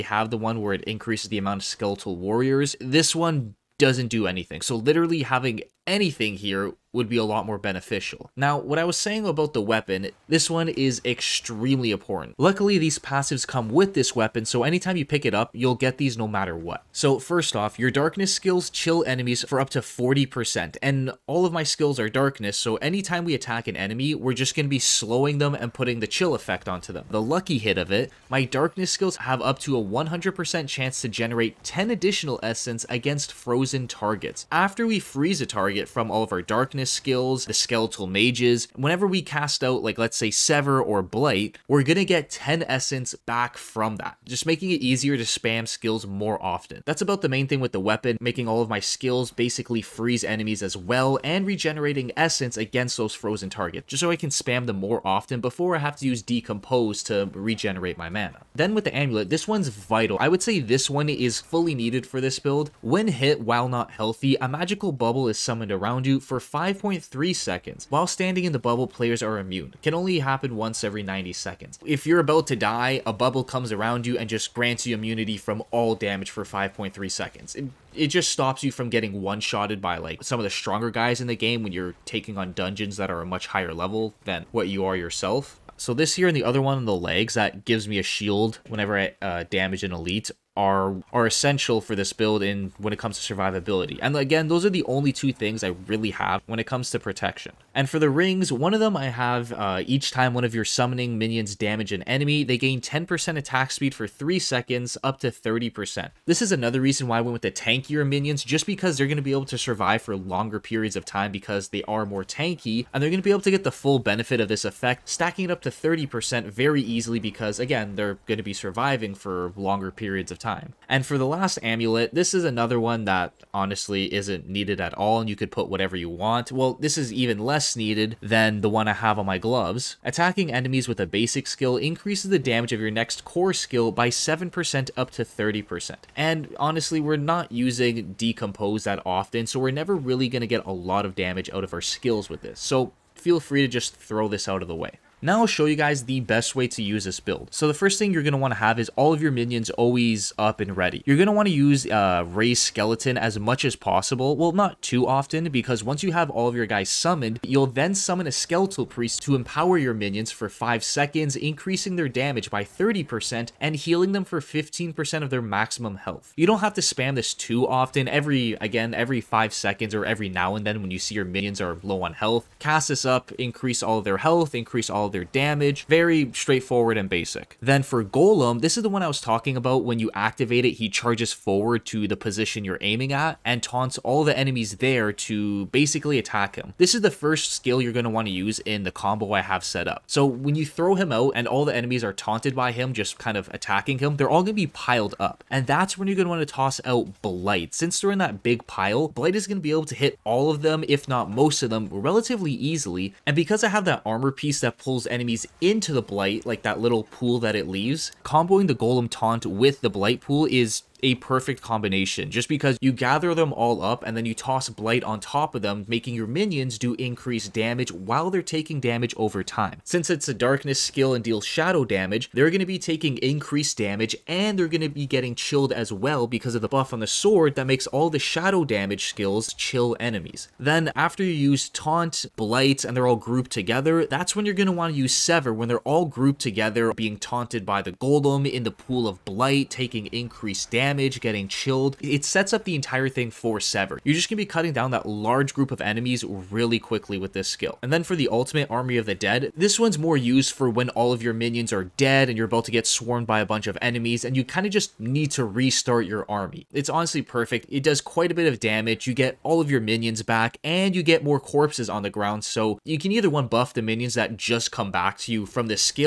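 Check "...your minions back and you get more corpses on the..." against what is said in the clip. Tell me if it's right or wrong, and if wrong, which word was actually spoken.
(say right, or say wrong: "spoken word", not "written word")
right.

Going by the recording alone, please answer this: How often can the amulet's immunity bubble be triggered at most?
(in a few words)
once every 90 seconds.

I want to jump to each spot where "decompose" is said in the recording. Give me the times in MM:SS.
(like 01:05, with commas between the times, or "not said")
00:56, 02:18.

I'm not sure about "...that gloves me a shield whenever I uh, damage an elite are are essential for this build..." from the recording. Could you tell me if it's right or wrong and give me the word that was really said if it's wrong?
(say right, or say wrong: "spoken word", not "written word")
wrong: "gives", not "gloves".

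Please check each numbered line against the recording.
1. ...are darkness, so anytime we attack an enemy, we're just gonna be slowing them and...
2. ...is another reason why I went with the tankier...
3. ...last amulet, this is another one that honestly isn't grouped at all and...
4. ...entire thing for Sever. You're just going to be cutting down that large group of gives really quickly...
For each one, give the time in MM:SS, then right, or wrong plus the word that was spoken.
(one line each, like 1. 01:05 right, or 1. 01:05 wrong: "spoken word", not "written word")
1. 00:21 right
2. 01:46 right
3. 02:01 wrong: "needed", not "grouped"
4. 04:02 wrong: "enemies", not "gives".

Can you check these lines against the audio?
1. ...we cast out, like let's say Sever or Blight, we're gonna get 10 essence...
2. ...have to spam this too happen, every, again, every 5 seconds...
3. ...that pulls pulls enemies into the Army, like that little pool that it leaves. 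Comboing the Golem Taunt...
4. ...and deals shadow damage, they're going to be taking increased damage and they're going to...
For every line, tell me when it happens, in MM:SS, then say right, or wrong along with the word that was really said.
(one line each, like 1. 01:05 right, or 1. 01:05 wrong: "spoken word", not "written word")
1. 00:39 right
2. 02:46 wrong: "often", not "happen"
3. 03:24 wrong: "Blight", not "Army"
4. 03:41 right.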